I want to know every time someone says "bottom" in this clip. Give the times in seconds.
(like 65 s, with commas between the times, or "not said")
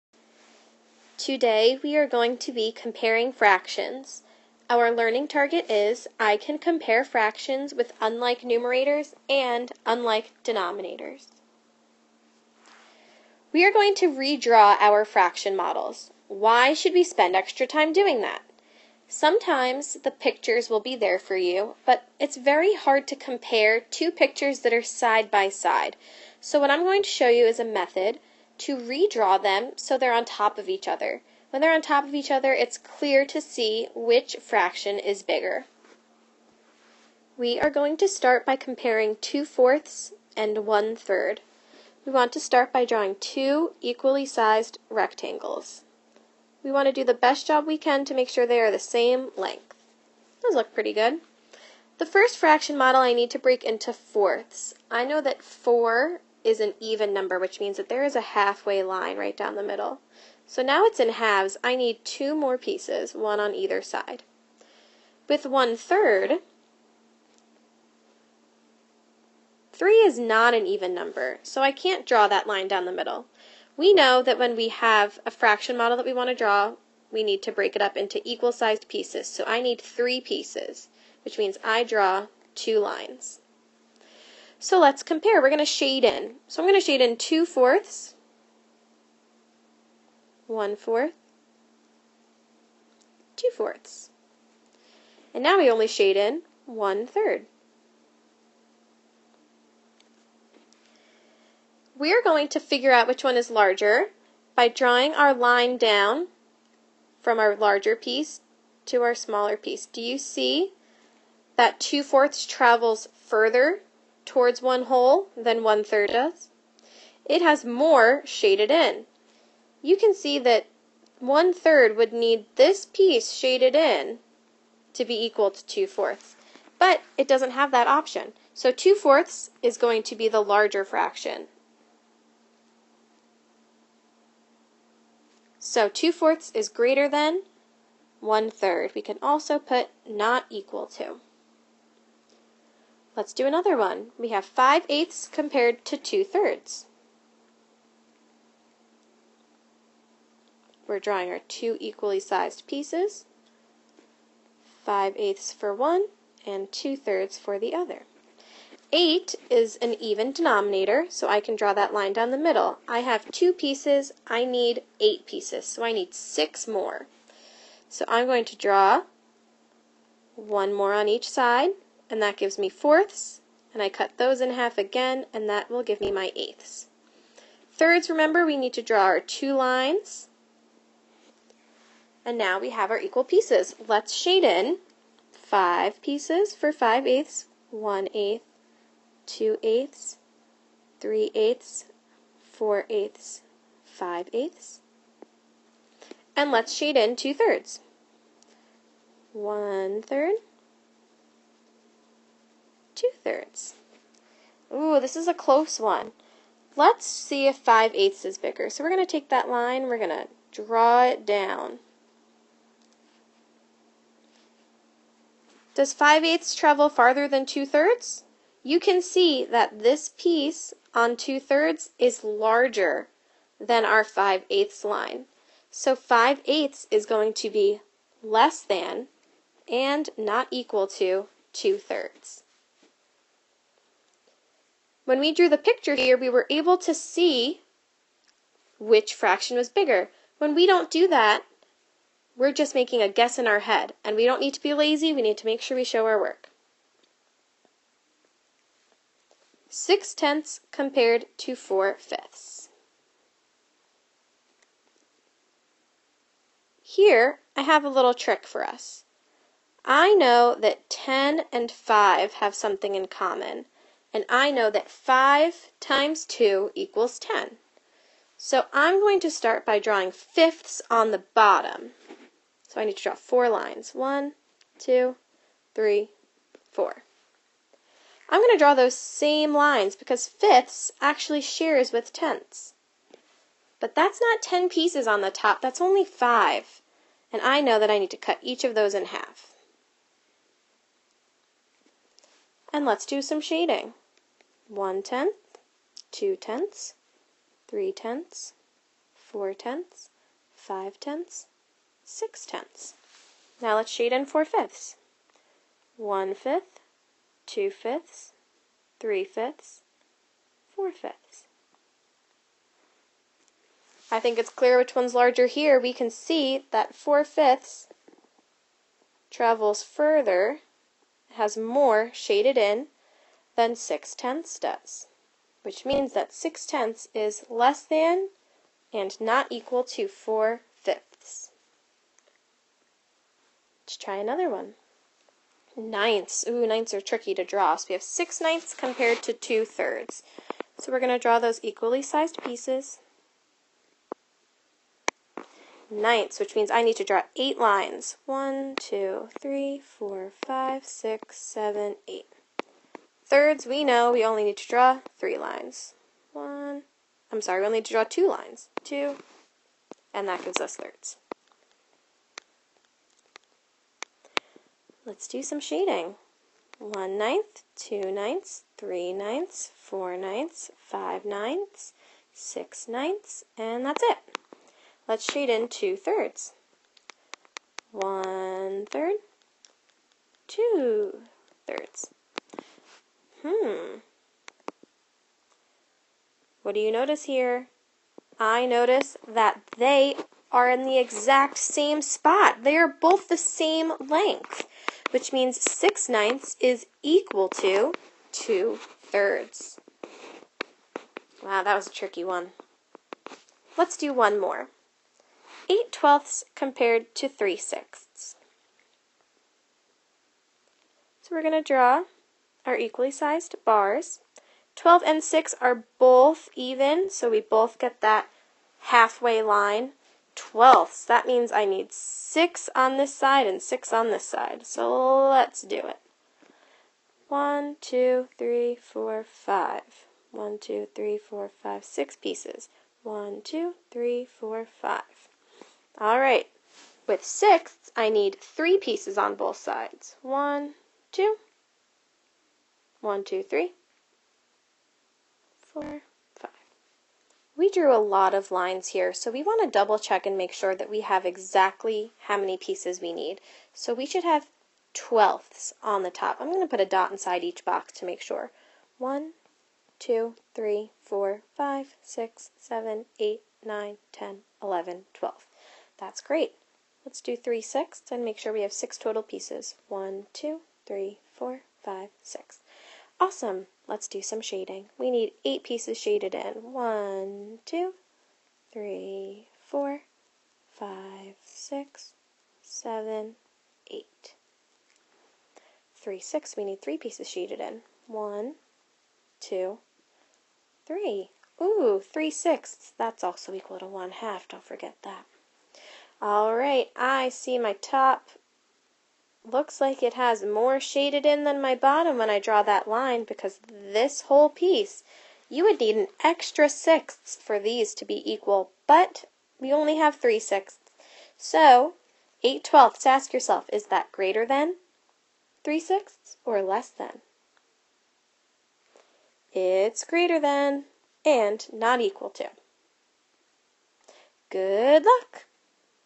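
271 s, 501 s.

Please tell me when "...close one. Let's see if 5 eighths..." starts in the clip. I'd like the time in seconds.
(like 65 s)
205 s.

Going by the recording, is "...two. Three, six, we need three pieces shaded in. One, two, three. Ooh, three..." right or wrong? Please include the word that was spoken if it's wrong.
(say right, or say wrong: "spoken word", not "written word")
wrong: "eight", not "two".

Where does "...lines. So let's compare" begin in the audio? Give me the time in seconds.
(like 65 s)
82 s.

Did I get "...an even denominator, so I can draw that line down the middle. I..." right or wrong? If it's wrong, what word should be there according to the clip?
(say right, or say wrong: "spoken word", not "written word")
right.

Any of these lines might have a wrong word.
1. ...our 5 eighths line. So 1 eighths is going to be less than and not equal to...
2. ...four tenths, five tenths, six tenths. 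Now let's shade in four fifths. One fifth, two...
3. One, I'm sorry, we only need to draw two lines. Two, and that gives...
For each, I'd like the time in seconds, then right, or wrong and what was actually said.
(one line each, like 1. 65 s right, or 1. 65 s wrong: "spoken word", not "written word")
1. 223 s wrong: "5", not "1"
2. 299 s right
3. 356 s right.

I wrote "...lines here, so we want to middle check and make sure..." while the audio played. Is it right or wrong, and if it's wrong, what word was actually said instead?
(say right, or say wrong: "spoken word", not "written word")
wrong: "double", not "middle".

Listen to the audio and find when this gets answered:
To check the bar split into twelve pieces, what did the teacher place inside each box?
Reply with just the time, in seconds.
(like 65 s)
456 s.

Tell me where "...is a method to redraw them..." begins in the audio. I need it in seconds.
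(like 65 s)
27 s.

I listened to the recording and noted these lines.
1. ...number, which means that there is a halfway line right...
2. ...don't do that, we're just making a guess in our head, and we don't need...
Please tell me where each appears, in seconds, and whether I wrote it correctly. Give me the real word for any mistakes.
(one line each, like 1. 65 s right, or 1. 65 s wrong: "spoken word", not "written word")
1. 57 s right
2. 240 s right.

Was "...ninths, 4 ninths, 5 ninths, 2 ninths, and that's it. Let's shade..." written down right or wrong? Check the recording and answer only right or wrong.
wrong.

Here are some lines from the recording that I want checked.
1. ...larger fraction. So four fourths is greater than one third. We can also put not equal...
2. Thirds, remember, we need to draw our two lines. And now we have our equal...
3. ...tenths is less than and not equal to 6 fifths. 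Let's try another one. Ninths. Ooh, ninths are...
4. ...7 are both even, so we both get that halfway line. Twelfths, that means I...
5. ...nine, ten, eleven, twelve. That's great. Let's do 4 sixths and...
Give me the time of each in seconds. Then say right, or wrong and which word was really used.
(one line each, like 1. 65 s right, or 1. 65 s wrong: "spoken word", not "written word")
1. 130 s wrong: "two", not "four"
2. 177 s right
3. 326 s wrong: "4", not "6"
4. 415 s wrong: "6", not "7"
5. 463 s wrong: "3", not "4".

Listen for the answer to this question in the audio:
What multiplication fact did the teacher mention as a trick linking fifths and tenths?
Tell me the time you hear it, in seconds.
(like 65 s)
264 s.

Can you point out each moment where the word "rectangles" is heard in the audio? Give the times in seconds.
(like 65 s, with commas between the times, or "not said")
44 s.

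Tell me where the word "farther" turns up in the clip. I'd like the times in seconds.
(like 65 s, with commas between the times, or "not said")
216 s.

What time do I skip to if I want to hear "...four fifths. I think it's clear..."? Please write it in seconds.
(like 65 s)
310 s.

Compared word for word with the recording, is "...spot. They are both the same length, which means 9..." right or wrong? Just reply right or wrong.
wrong.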